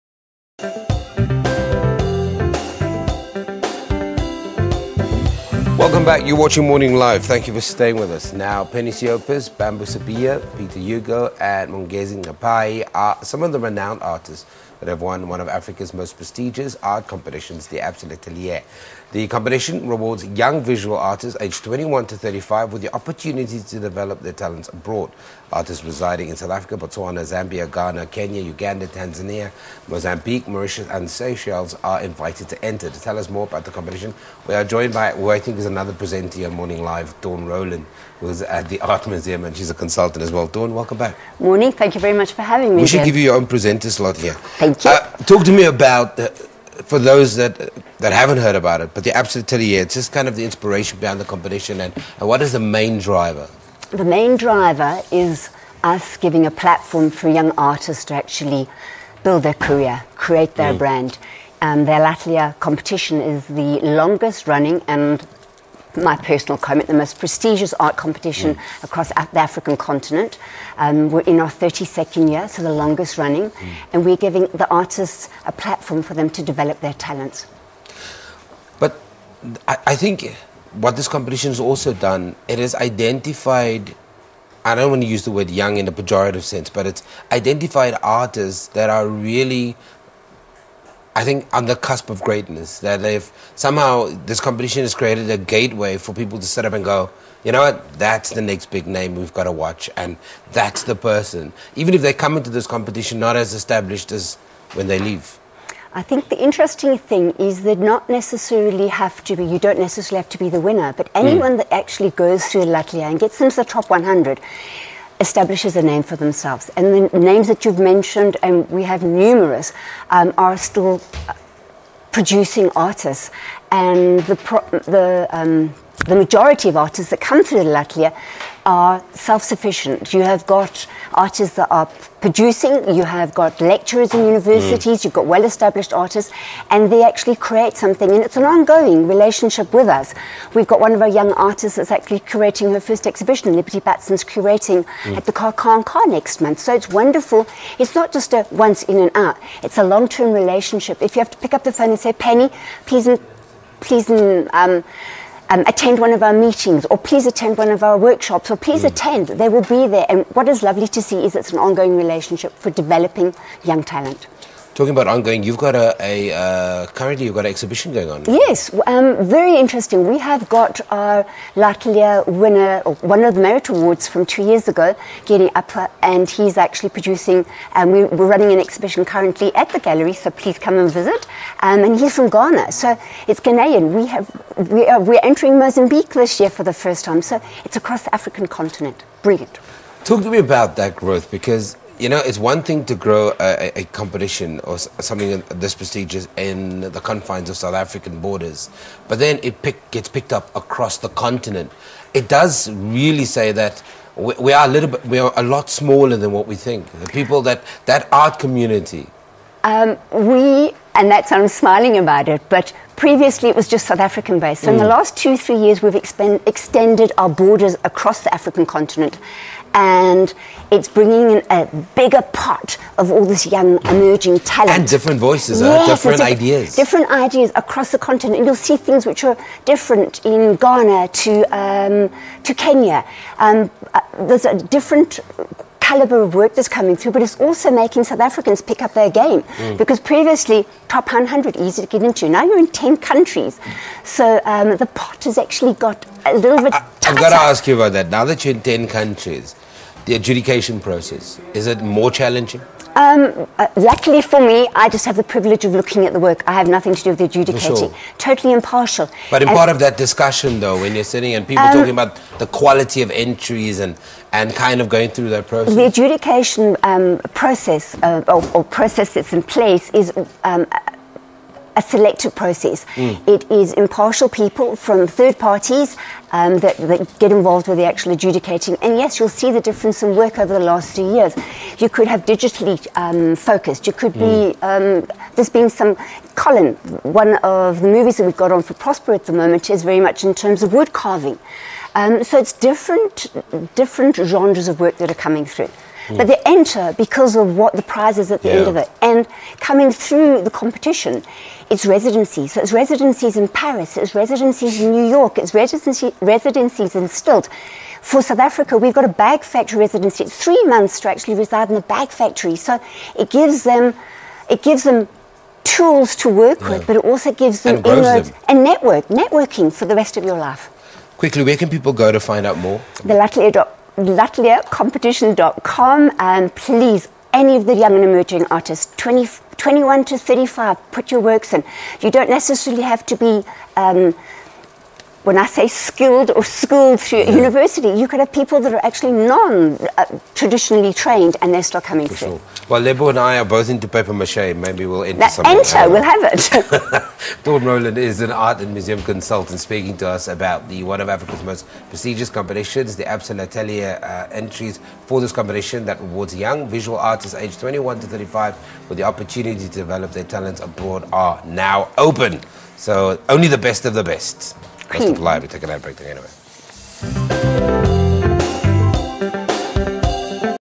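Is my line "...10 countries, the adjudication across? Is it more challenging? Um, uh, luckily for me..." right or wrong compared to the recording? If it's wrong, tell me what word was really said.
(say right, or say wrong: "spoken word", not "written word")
wrong: "process", not "across".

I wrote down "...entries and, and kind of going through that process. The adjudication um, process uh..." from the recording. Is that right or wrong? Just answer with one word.
right.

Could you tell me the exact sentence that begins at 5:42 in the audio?
Well, Lebo and I are both into paper mache.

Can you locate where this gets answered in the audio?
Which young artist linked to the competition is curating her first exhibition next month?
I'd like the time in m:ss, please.
2:23.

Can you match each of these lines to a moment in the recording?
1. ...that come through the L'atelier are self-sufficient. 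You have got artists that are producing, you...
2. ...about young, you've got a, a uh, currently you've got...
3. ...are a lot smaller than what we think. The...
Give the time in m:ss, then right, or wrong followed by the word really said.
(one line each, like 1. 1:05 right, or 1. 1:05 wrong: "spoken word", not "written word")
1. 2:07 right
2. 2:44 wrong: "ongoing", not "young"
3. 3:25 right.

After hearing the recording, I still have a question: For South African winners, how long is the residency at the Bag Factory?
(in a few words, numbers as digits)
3 months.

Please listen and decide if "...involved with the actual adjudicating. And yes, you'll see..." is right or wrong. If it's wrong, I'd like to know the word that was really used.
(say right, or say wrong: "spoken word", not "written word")
right.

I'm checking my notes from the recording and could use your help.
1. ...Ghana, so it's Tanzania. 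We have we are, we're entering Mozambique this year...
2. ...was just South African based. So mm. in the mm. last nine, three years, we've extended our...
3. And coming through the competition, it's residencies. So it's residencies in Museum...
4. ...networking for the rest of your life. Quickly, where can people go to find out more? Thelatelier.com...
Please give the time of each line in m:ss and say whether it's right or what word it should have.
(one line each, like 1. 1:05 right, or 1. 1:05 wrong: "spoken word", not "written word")
1. 3:02 wrong: "Ghanaian", not "Tanzania"
2. 3:33 wrong: "two", not "nine"
3. 4:59 wrong: "Paris", not "Museum"
4. 5:19 right.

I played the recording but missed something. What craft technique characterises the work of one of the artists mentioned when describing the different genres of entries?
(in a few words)
Wood carving.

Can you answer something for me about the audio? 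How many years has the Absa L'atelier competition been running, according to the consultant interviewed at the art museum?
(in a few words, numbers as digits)
32.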